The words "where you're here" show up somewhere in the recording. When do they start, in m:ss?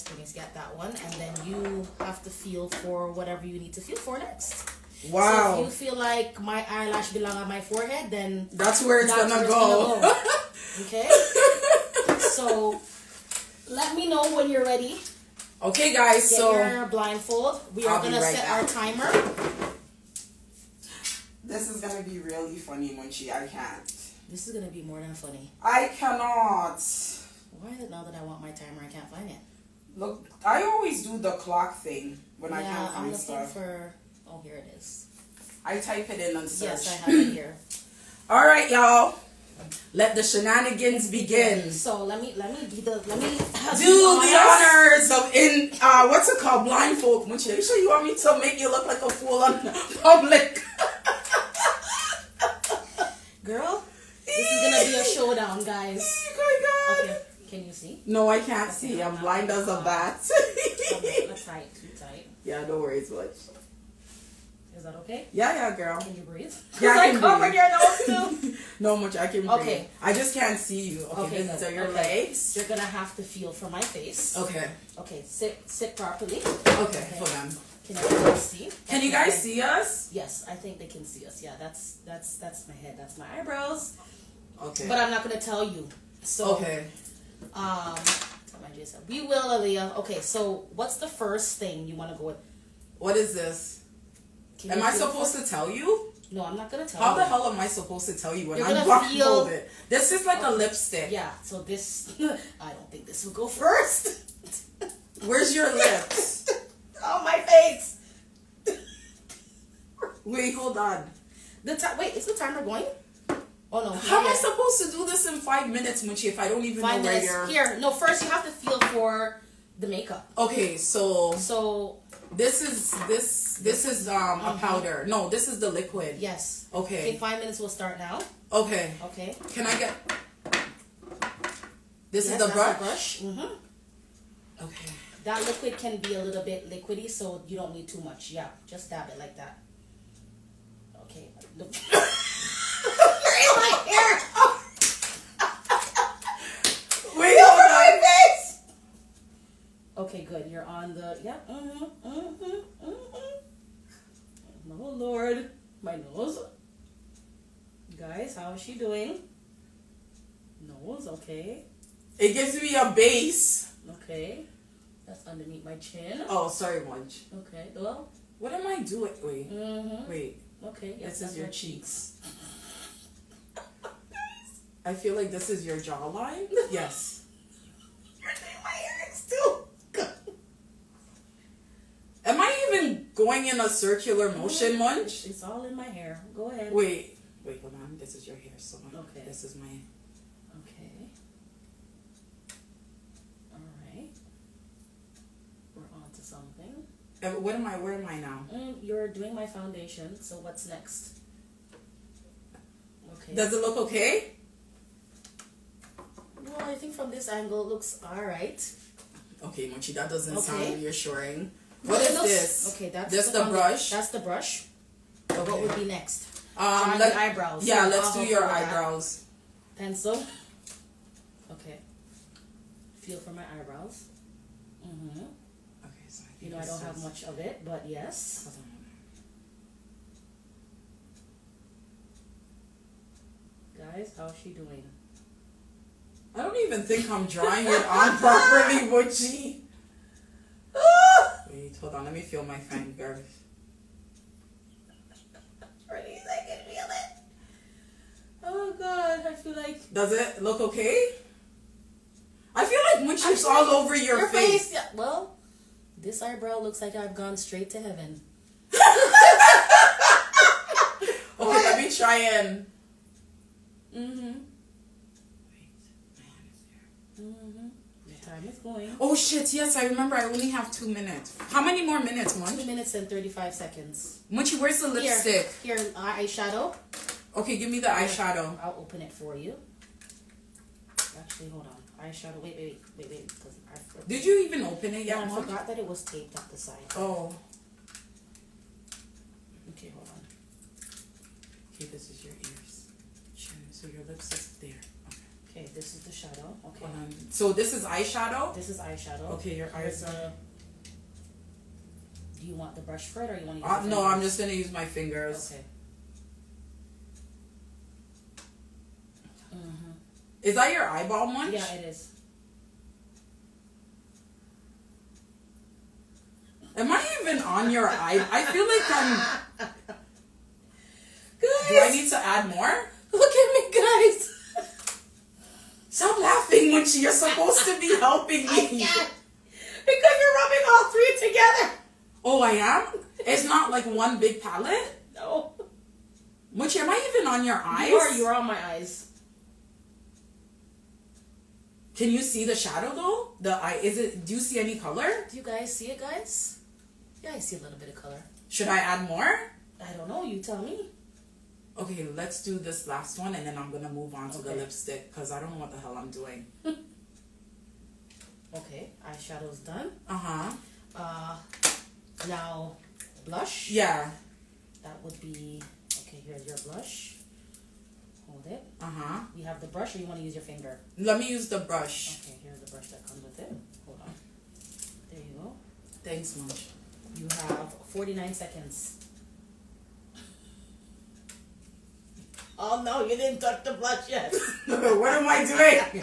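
1:57.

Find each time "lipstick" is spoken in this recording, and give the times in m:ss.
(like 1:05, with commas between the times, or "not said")
1:40, 4:34, 4:54, 5:54.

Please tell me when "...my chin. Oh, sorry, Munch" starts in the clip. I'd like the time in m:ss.
2:45.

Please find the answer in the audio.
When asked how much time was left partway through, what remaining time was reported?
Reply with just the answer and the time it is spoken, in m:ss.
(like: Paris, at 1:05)
2 minutes and 35 seconds, at 4:32.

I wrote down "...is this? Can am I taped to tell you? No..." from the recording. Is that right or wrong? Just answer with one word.
wrong.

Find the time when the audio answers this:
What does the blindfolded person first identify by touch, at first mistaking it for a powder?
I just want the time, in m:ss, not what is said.
2:05.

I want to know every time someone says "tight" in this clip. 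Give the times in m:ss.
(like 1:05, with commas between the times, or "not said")
1:01.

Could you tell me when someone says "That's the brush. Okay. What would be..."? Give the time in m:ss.
3:33.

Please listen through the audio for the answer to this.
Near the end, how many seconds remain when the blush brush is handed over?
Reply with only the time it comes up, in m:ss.
6:17.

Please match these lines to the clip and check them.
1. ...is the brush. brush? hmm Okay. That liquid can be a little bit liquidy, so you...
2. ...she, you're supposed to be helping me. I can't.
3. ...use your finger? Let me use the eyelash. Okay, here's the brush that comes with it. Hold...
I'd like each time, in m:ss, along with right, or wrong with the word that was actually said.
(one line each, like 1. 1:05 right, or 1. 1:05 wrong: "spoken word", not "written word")
1. 2:12 right
2. 5:26 right
3. 6:10 wrong: "brush", not "eyelash".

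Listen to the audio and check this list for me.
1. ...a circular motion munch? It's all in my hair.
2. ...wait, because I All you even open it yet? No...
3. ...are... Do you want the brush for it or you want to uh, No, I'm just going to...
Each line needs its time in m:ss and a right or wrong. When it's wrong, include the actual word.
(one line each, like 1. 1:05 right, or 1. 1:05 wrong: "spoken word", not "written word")
1. 3:03 right
2. 4:43 wrong: "Did", not "All"
3. 5:00 right.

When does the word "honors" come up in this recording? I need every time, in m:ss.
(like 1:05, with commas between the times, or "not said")
0:44.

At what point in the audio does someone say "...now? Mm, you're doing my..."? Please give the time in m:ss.
3:18.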